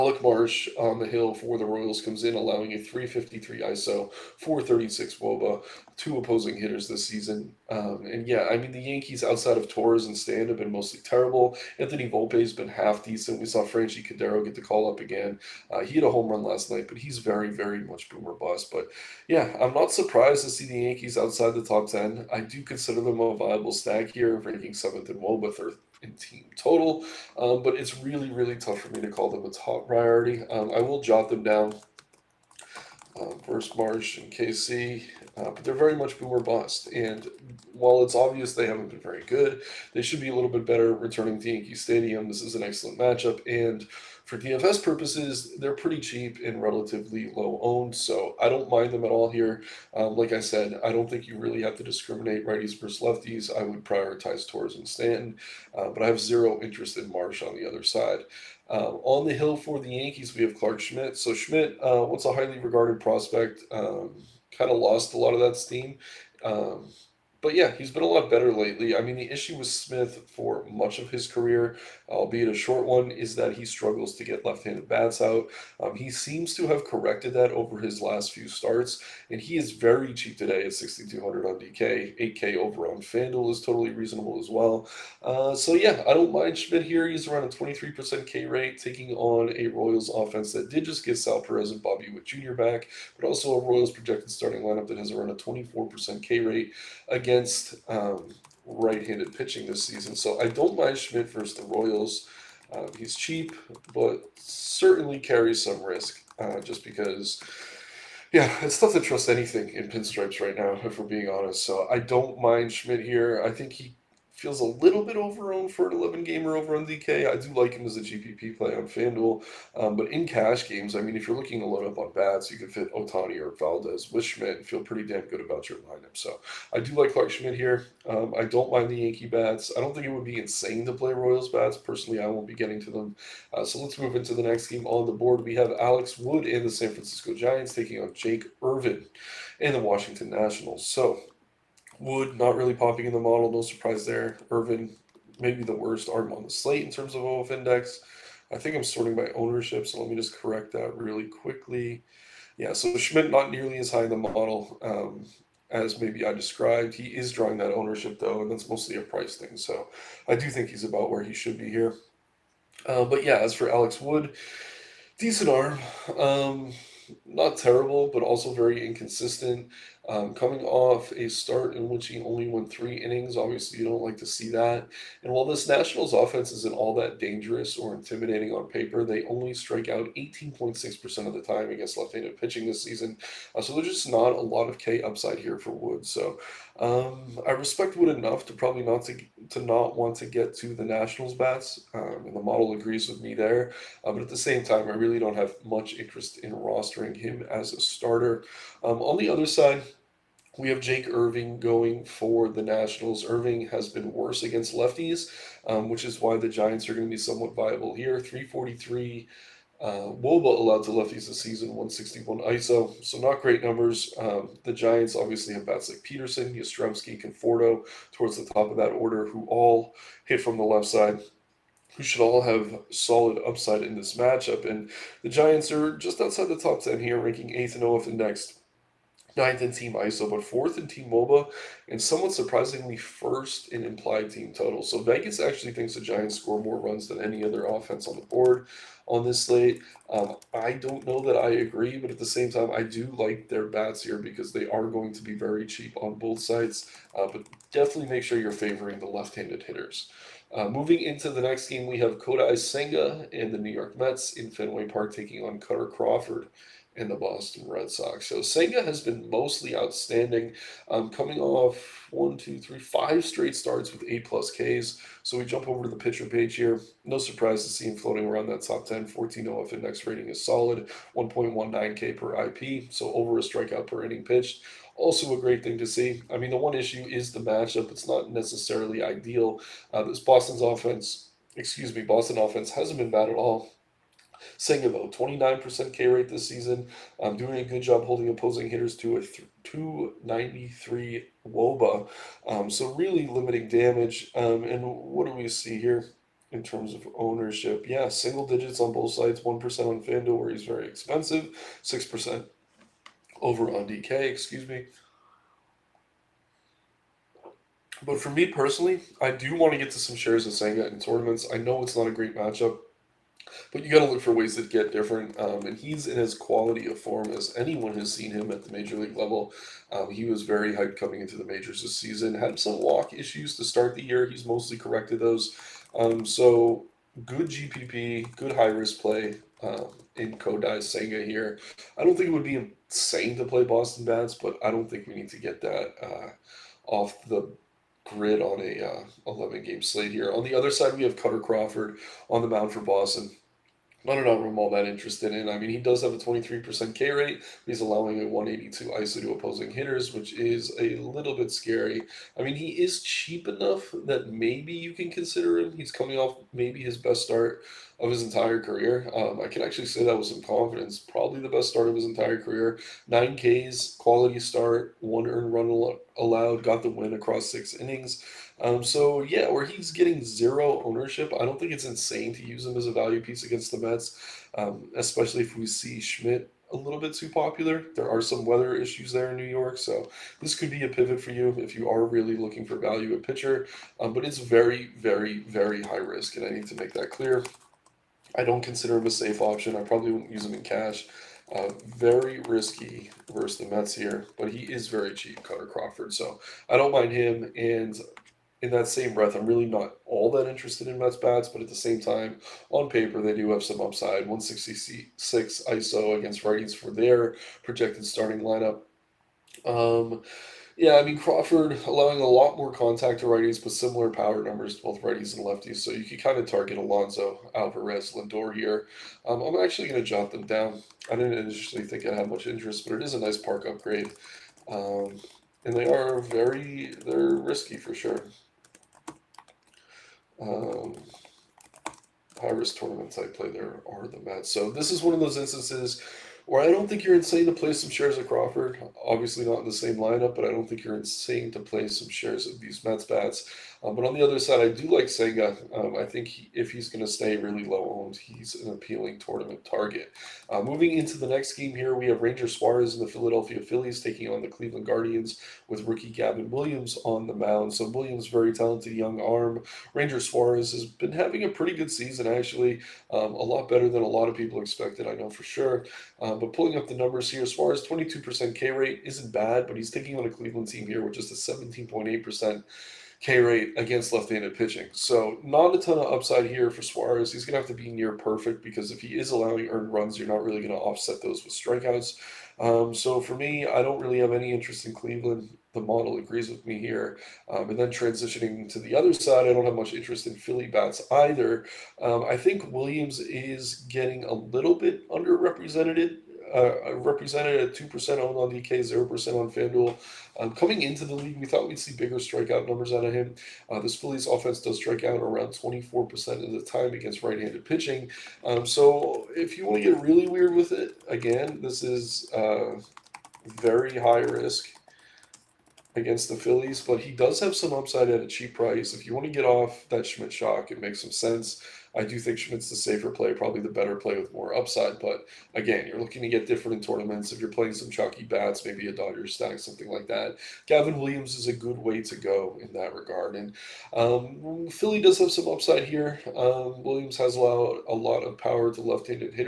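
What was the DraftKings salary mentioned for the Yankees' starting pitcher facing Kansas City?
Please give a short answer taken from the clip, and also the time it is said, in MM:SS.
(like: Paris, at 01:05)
$6,200, at 01:20.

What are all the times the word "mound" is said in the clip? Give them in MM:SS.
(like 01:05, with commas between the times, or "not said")
05:42, 07:37.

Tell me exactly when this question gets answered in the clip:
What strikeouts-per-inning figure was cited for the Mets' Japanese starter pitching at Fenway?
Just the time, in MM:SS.
04:31.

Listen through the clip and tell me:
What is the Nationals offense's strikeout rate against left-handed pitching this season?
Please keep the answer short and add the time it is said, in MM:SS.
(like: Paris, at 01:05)
18.6%, at 03:00.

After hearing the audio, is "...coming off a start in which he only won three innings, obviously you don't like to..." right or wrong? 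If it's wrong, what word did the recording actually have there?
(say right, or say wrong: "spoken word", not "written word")
right.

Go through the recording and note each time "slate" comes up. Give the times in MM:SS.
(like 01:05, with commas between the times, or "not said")
02:26, 03:59, 05:39.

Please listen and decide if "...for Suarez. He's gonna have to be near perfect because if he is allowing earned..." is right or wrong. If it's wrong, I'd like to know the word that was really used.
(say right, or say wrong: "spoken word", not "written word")
right.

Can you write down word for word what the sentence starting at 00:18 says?
But yeah, I'm not surprised to see the Yankees outside the top 10.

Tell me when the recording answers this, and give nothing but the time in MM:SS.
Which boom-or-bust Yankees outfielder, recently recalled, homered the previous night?
00:13.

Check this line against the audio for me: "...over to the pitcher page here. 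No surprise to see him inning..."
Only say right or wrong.
wrong.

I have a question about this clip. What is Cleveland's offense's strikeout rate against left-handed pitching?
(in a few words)
17.8%.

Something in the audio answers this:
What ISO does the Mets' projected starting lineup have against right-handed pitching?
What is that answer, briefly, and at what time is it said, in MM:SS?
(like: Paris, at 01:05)
166, at 06:44.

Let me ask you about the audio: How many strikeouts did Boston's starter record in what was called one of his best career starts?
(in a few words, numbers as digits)
9.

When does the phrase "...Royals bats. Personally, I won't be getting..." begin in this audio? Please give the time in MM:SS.
02:11.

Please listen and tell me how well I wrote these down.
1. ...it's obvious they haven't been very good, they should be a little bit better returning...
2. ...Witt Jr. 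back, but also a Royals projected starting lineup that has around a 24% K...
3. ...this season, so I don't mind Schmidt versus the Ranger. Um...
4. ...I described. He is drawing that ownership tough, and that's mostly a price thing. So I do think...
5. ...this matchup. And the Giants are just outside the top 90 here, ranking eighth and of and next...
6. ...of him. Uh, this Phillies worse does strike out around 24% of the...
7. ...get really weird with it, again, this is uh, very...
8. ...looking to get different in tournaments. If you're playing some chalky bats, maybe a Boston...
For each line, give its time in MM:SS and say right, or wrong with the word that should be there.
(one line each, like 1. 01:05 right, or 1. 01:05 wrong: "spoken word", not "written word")
1. 00:38 right
2. 01:32 right
3. 01:39 wrong: "Royals", not "Ranger"
4. 02:36 wrong: "though", not "tough"
5. 03:43 wrong: "10", not "90"
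6. 08:23 wrong: "offense", not "worse"
7. 08:29 right
8. 08:45 wrong: "Dodgers", not "Boston".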